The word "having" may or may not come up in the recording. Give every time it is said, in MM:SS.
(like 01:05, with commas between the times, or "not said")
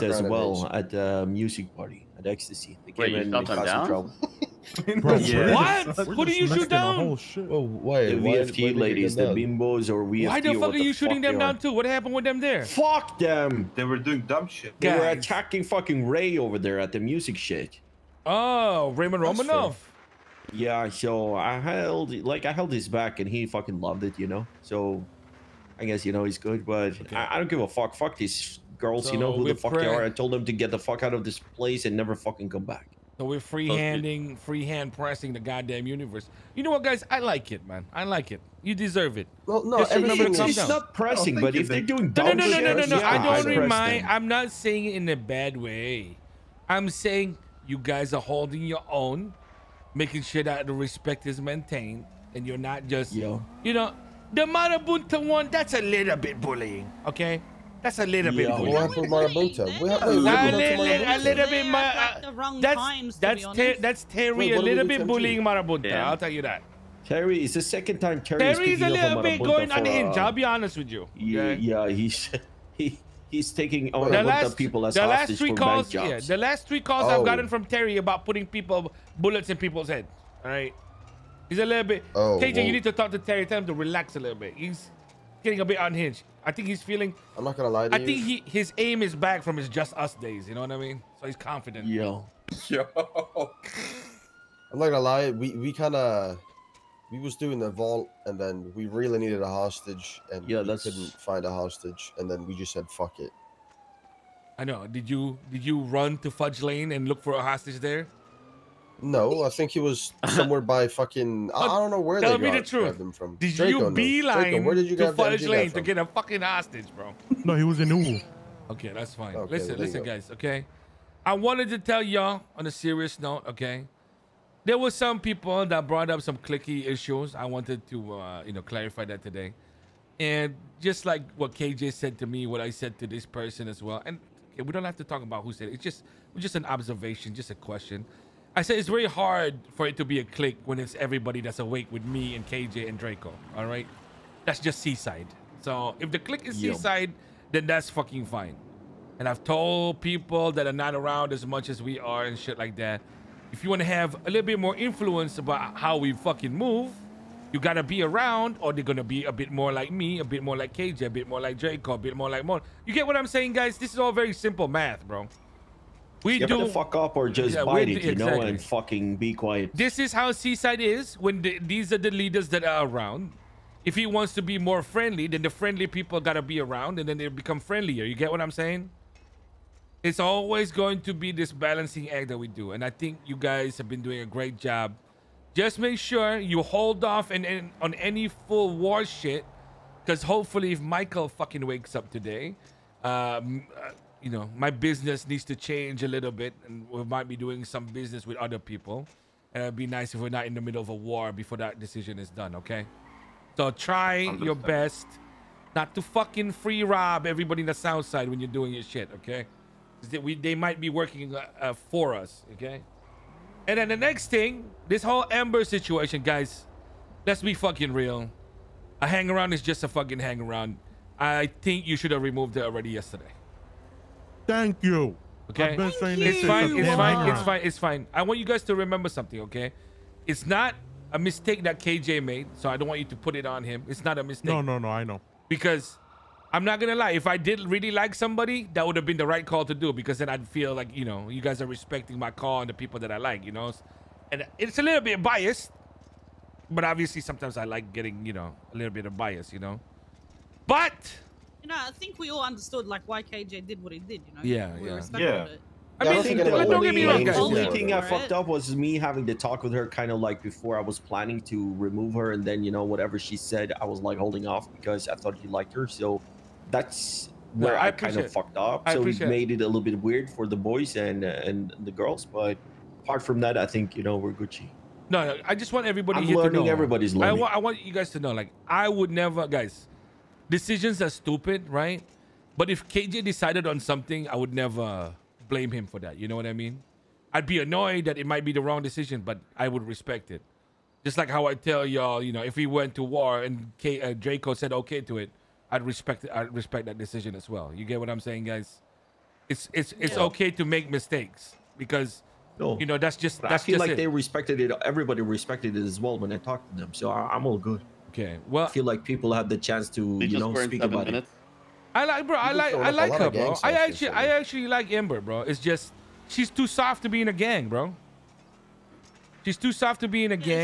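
04:18.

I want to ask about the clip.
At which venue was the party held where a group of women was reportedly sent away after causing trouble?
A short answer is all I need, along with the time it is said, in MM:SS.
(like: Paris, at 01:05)
Ecstasy, at 00:02.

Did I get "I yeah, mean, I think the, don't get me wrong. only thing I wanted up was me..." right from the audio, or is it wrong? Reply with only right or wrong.
wrong.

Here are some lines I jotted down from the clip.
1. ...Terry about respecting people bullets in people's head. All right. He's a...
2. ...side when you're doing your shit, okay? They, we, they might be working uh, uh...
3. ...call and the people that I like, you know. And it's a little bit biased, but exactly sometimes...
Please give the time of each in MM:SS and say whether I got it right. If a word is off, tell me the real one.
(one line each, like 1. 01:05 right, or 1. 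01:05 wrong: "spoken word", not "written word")
1. 01:17 wrong: "putting", not "respecting"
2. 03:28 right
3. 04:02 wrong: "obviously", not "exactly".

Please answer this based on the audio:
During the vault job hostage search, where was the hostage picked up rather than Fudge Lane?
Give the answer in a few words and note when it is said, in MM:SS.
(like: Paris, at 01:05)
Uwu, at 01:57.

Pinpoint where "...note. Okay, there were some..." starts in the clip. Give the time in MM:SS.
02:03.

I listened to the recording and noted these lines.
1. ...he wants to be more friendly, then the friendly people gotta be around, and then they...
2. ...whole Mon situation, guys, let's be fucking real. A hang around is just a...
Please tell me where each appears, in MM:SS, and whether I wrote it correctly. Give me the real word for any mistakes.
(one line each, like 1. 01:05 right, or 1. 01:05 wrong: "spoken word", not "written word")
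1. 02:53 right
2. 03:35 wrong: "Amber", not "Mon".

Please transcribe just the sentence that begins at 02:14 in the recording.
And okay, we don't have to talk about who said it.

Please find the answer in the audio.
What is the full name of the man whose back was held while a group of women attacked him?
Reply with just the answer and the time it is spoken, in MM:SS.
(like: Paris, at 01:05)
Raymond Romanoff, at 00:18.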